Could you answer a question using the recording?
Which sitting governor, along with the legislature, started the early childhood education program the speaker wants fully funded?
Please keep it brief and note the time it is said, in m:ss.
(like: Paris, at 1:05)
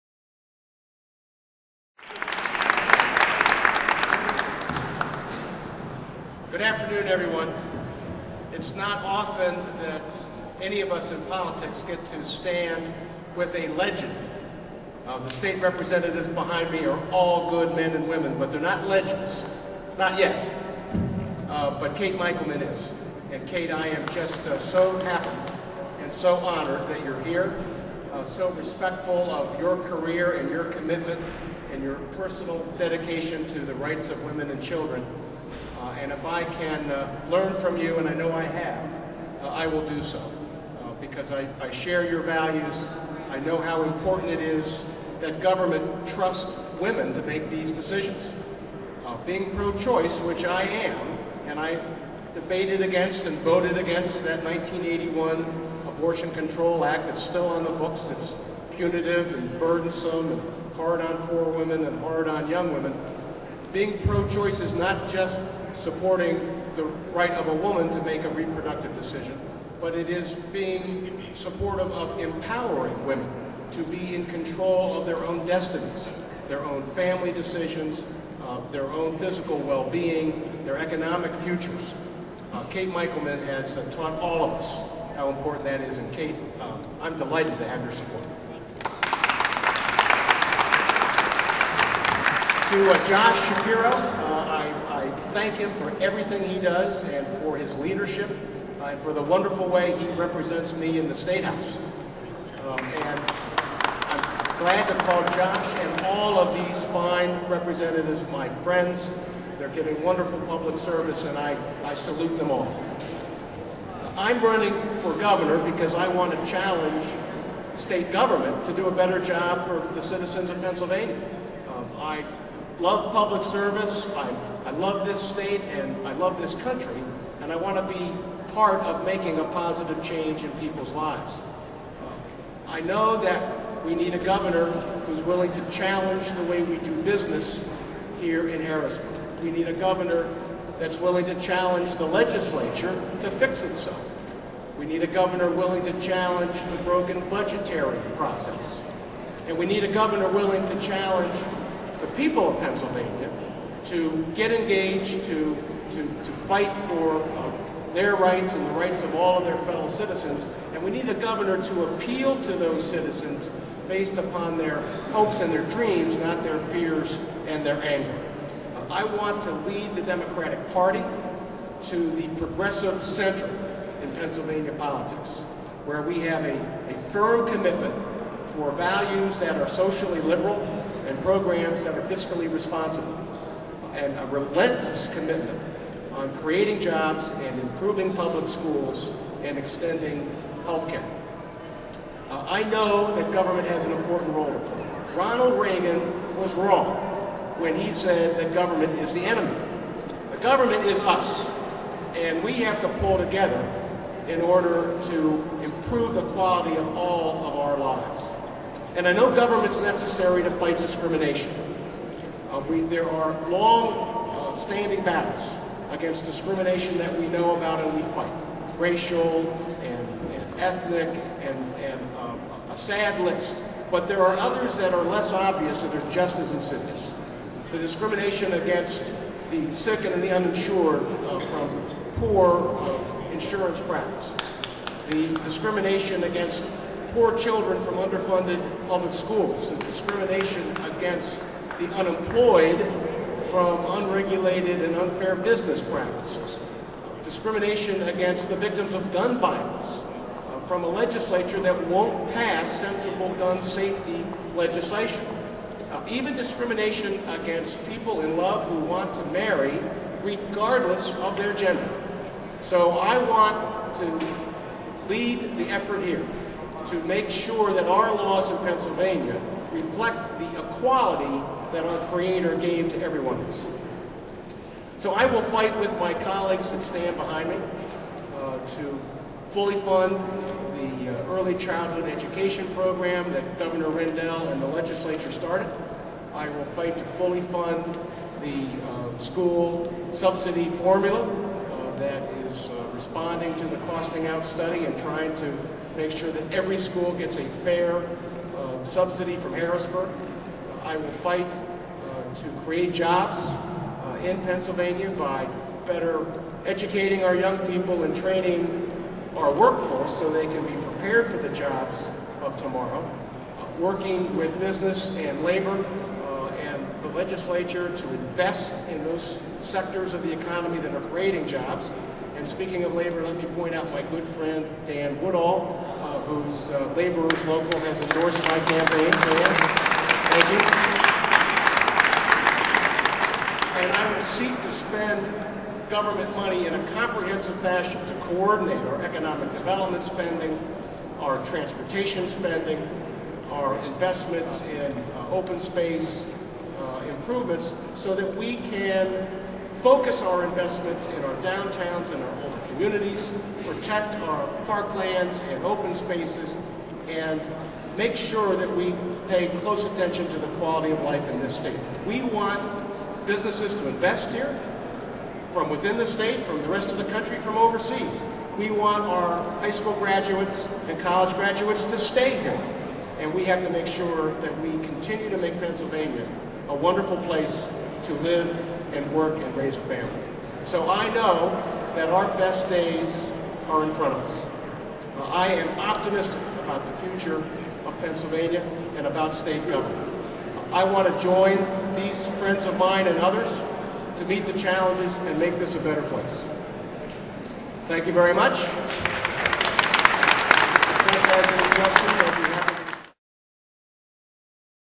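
Governor Rendell, at 4:43.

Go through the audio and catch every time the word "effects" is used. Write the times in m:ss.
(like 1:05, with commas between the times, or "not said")
not said.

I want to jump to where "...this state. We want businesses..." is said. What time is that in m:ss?
6:01.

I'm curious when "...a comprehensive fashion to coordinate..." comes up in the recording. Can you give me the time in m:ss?
5:36.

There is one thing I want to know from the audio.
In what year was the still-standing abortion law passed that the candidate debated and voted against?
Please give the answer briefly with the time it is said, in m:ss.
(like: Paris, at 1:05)
1981, at 0:54.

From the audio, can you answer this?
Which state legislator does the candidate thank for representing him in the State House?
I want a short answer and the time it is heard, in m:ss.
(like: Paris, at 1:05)
Josh Shapiro, at 1:33.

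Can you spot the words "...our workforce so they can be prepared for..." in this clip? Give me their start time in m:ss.
5:09.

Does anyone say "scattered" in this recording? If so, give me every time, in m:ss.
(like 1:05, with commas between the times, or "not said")
not said.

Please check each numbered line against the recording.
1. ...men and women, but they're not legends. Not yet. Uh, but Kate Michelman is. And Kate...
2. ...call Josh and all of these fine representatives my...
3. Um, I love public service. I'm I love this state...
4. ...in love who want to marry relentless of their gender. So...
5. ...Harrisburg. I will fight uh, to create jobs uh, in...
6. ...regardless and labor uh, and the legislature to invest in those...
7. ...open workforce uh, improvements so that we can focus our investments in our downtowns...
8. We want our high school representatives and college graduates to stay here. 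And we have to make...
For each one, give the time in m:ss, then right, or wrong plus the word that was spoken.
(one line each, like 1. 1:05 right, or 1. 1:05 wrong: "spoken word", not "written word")
1. 0:17 right
2. 1:45 right
3. 2:01 right
4. 4:18 wrong: "regardless", not "relentless"
5. 4:59 right
6. 5:14 wrong: "business", not "regardless"
7. 5:45 wrong: "space", not "workforce"
8. 6:08 wrong: "graduates", not "representatives".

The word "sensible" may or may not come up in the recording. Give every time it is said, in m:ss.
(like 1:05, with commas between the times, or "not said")
4:12.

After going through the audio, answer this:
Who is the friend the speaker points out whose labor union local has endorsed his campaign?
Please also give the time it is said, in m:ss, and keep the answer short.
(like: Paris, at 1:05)
Dan Woodall, at 5:24.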